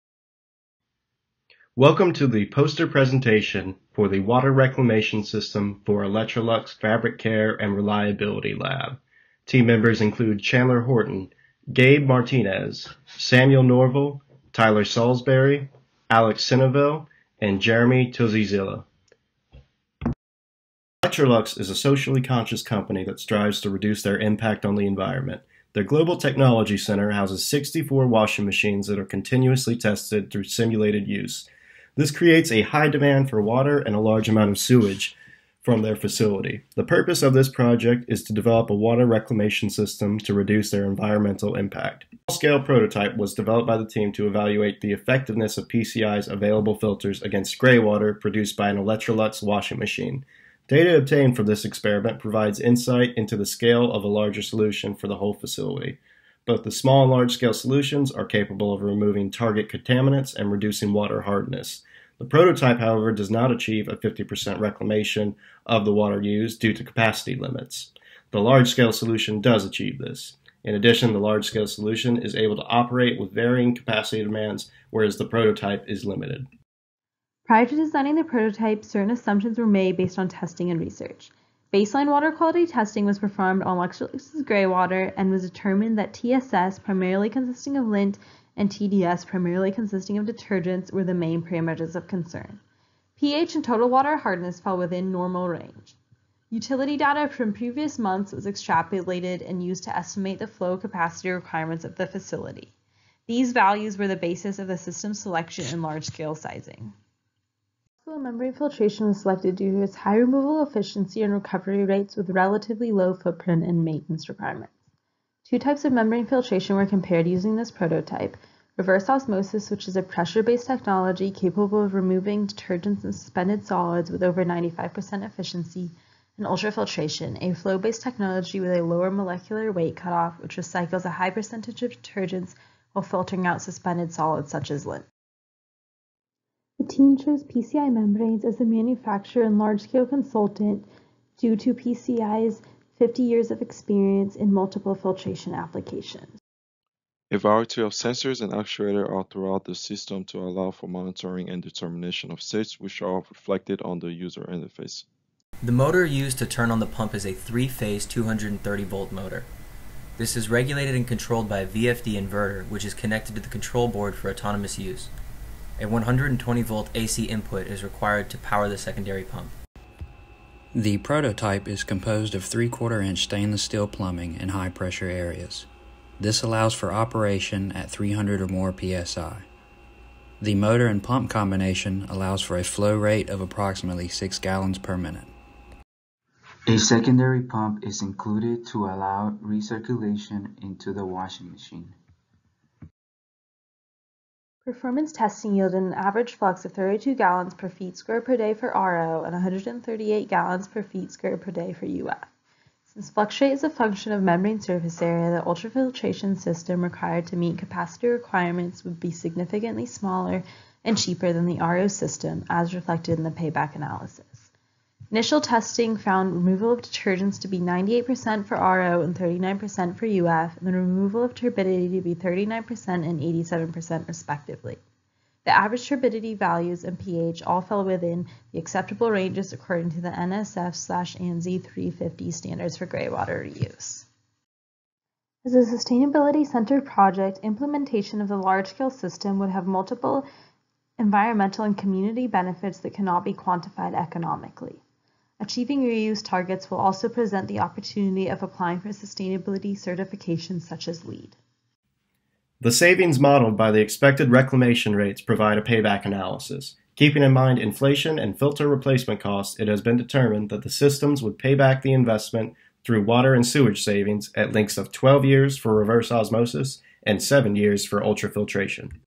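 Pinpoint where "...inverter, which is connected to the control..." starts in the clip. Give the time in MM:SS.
02:42.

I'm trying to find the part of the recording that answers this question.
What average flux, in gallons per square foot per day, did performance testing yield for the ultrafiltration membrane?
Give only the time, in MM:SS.
03:19.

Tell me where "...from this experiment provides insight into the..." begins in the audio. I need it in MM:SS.
00:51.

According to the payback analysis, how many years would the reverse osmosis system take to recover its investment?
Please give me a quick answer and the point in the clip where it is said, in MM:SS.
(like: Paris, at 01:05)
12 years, at 04:24.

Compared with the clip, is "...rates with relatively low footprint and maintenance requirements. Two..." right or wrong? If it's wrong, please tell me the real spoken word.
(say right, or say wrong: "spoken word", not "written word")
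right.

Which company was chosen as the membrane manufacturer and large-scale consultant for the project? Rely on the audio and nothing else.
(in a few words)
PCI Membranes.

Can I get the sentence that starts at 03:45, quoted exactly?
The average turbidity values and pH all fell within the acceptable ranges according to the NSF ANSI 350 standards for graywater reuse.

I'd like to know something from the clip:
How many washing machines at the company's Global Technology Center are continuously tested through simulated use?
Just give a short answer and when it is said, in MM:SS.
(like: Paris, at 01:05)
64, at 00:27.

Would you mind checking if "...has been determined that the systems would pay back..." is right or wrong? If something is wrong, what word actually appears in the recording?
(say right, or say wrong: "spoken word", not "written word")
right.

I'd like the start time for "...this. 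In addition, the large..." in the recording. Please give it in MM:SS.
01:09.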